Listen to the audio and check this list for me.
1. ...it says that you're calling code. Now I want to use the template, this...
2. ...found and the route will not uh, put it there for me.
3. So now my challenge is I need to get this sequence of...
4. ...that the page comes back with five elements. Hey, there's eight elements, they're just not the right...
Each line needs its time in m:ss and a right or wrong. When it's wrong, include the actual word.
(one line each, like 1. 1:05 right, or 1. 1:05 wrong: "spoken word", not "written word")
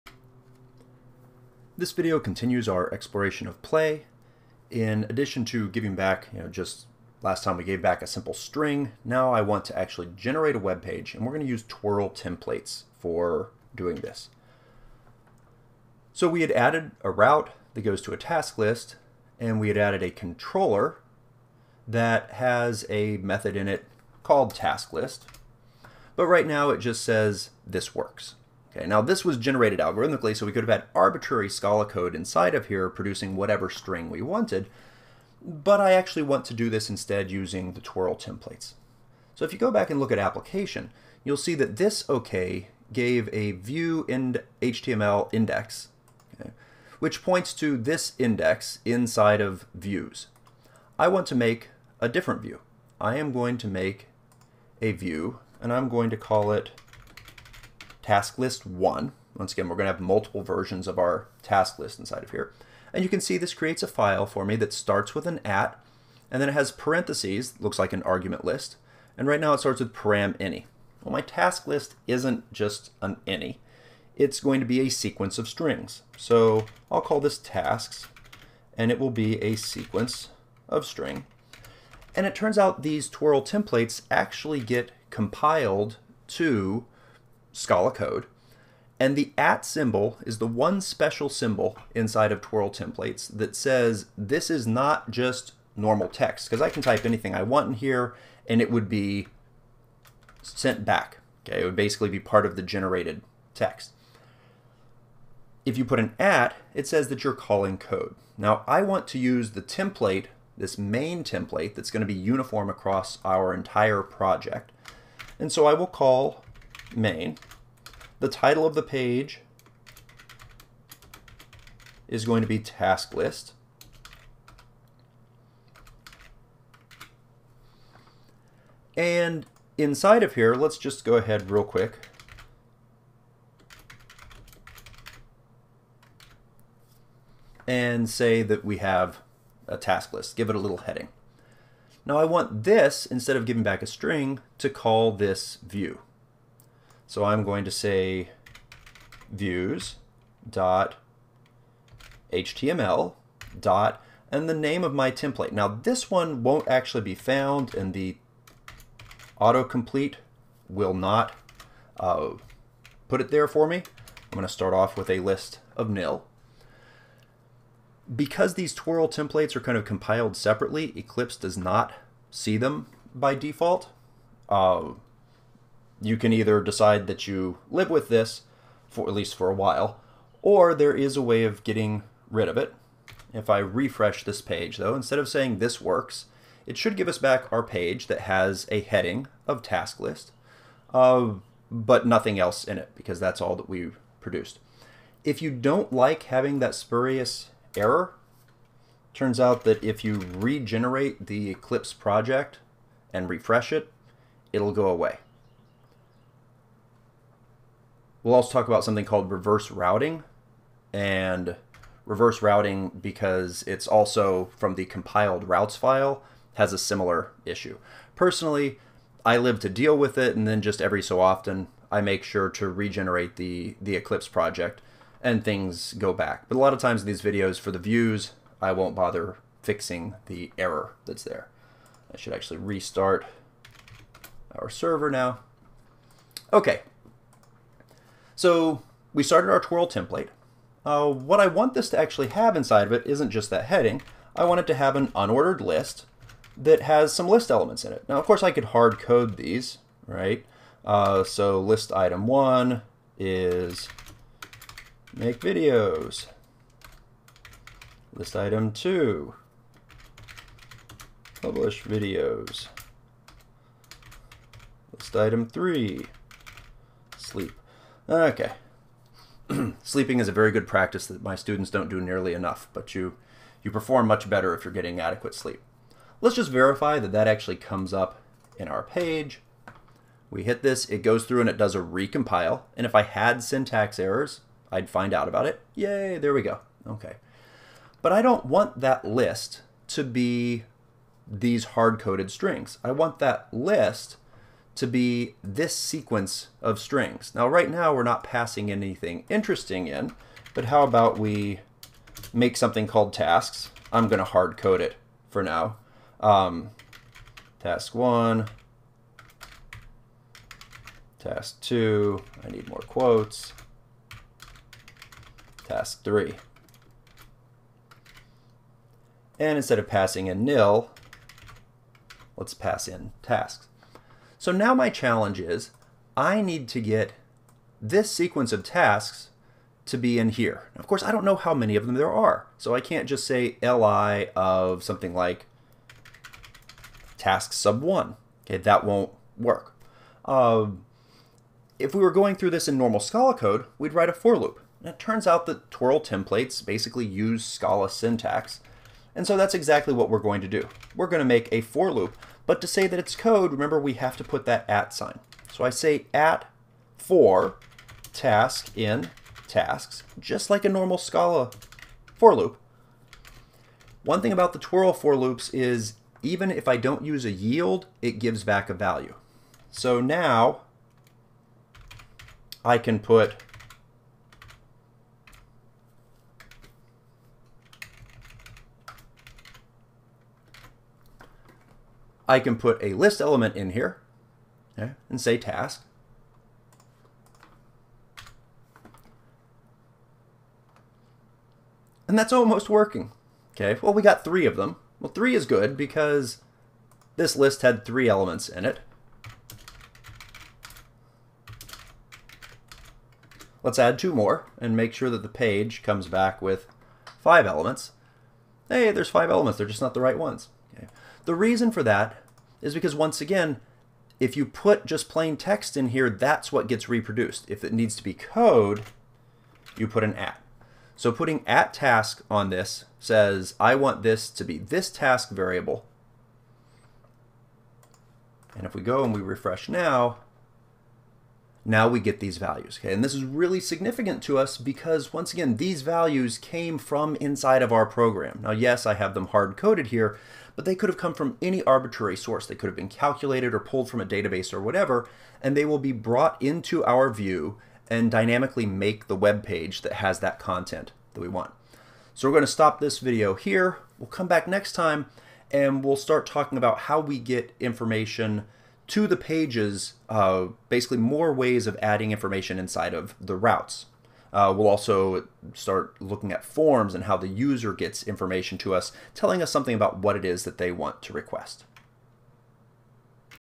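1. 1:46 right
2. 2:37 wrong: "autocomplete", not "route"
3. 5:24 right
4. 6:45 wrong: "five", not "eight".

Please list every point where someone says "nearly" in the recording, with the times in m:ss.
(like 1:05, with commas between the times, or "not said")
4:32.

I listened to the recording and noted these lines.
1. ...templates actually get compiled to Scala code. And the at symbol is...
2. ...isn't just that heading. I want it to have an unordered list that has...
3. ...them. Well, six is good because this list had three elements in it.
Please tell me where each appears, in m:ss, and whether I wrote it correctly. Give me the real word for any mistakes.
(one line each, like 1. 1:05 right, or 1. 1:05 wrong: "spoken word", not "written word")
1. 1:23 right
2. 4:03 right
3. 6:34 wrong: "three", not "six".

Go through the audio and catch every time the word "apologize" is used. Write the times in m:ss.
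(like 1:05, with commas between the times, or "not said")
not said.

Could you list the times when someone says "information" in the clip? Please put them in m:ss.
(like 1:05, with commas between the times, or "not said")
7:37, 7:42, 7:48.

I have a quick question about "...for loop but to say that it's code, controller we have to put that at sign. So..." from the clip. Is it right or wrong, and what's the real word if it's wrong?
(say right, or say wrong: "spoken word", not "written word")
wrong: "remember", not "controller".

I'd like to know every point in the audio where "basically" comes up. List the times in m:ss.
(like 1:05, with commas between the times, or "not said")
1:41, 5:46, 7:40.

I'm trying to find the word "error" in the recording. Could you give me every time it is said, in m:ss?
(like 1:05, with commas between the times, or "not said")
3:17, 3:50, 4:43.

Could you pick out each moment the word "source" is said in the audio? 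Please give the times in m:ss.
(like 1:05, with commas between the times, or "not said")
7:22.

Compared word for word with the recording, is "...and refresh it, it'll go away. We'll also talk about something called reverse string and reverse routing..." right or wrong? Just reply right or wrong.
wrong.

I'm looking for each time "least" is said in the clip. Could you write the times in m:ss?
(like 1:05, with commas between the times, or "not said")
2:59.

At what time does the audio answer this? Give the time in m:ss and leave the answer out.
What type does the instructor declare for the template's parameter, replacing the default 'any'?
1:19.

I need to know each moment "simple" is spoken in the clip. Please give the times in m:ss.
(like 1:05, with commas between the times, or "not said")
0:08.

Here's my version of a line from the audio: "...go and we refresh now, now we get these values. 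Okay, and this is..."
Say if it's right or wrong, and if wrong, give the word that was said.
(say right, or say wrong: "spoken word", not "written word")
right.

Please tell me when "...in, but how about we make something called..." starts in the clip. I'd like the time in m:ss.
4:59.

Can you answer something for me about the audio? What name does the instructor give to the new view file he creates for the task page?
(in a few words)
task list one.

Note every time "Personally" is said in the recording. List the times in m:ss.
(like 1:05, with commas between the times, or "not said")
3:38.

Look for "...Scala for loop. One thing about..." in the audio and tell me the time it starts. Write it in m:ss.
6:00.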